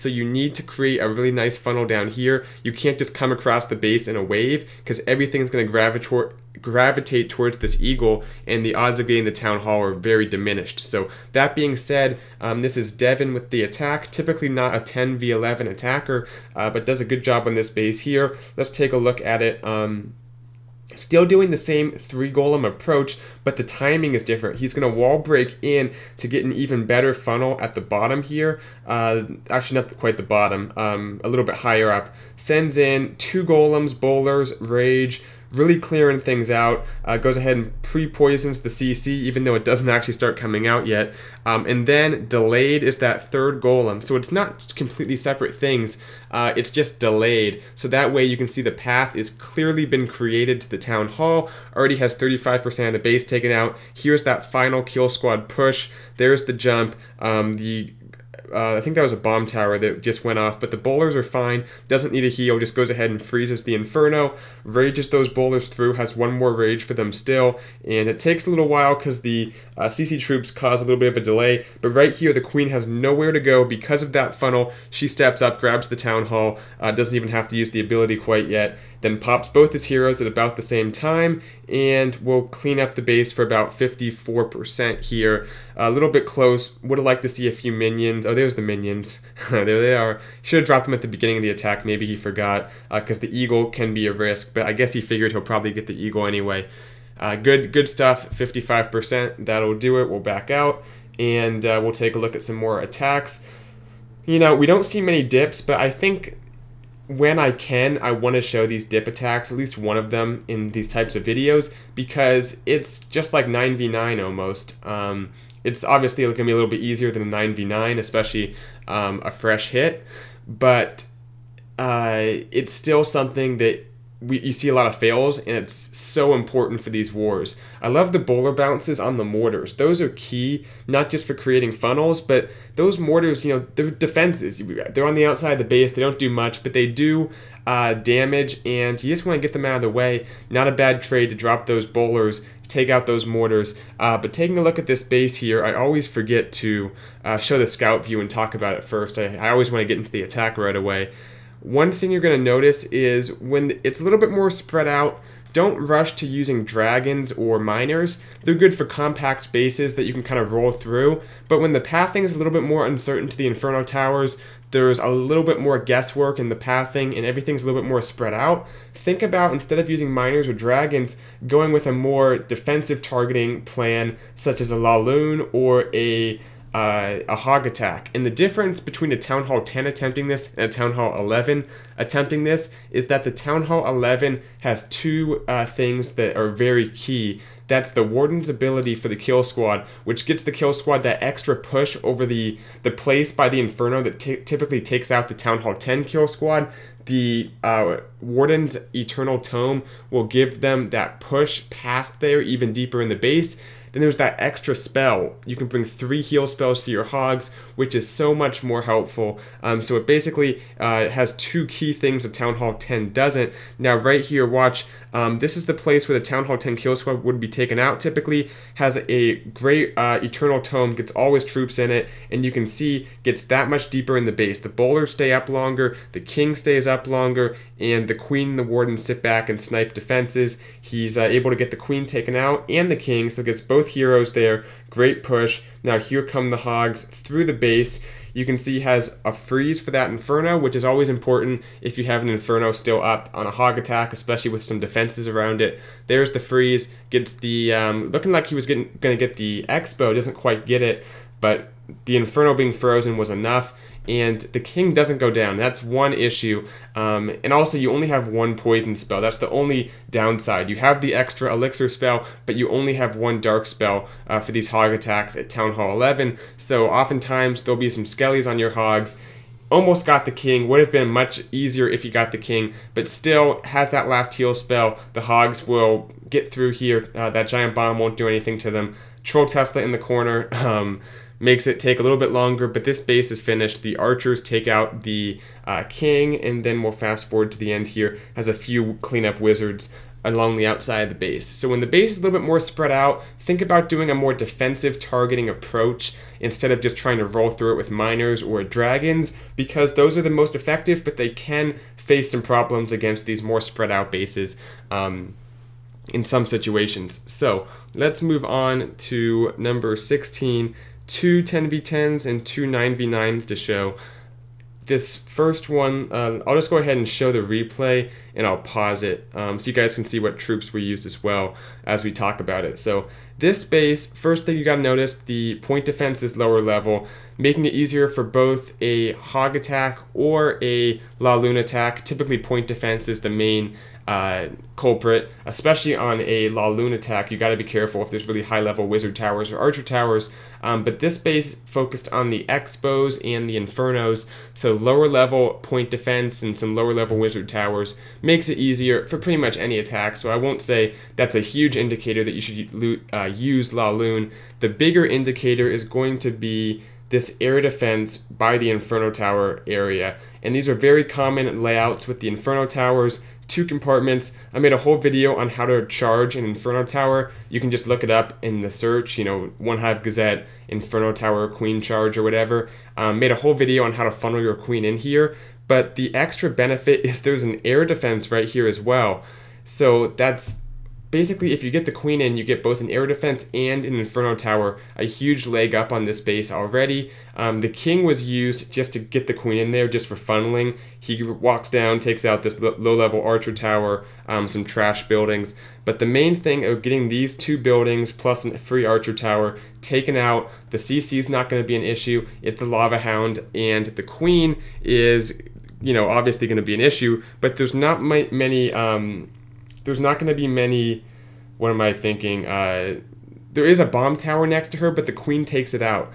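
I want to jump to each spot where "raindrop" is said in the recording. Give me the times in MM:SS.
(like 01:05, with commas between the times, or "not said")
not said.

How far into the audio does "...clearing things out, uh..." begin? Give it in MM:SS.
00:35.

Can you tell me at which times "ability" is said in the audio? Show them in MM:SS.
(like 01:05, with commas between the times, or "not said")
01:17, 03:08.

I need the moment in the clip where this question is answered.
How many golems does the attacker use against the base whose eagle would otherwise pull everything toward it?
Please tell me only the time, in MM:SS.
00:21.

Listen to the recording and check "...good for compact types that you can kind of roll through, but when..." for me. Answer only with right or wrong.
wrong.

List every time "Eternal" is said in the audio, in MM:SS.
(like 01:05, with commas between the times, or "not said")
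03:18, 03:40.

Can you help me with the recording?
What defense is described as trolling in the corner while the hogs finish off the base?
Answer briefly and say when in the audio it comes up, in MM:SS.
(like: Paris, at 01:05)
Troll Tesla, at 04:39.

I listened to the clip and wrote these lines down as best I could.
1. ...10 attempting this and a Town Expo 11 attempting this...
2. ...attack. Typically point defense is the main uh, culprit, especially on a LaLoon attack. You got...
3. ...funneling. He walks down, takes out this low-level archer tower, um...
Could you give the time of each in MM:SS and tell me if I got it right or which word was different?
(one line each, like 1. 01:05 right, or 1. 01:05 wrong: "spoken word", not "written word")
1. 02:59 wrong: "Hall", not "Expo"
2. 05:31 right
3. 06:30 right.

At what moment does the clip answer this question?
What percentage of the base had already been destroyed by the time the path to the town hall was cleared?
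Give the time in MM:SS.
00:52.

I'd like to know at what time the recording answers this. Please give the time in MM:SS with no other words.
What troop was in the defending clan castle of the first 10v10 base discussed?
06:42.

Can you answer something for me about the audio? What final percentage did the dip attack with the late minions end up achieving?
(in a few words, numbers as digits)
55%.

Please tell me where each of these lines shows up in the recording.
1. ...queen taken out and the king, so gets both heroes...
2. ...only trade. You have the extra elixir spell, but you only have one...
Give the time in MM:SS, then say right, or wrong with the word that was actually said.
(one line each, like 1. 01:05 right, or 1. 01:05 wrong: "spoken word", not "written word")
1. 03:51 right
2. 04:19 wrong: "downside", not "trade".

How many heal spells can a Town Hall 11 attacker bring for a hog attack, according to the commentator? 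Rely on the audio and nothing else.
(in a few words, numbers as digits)
3.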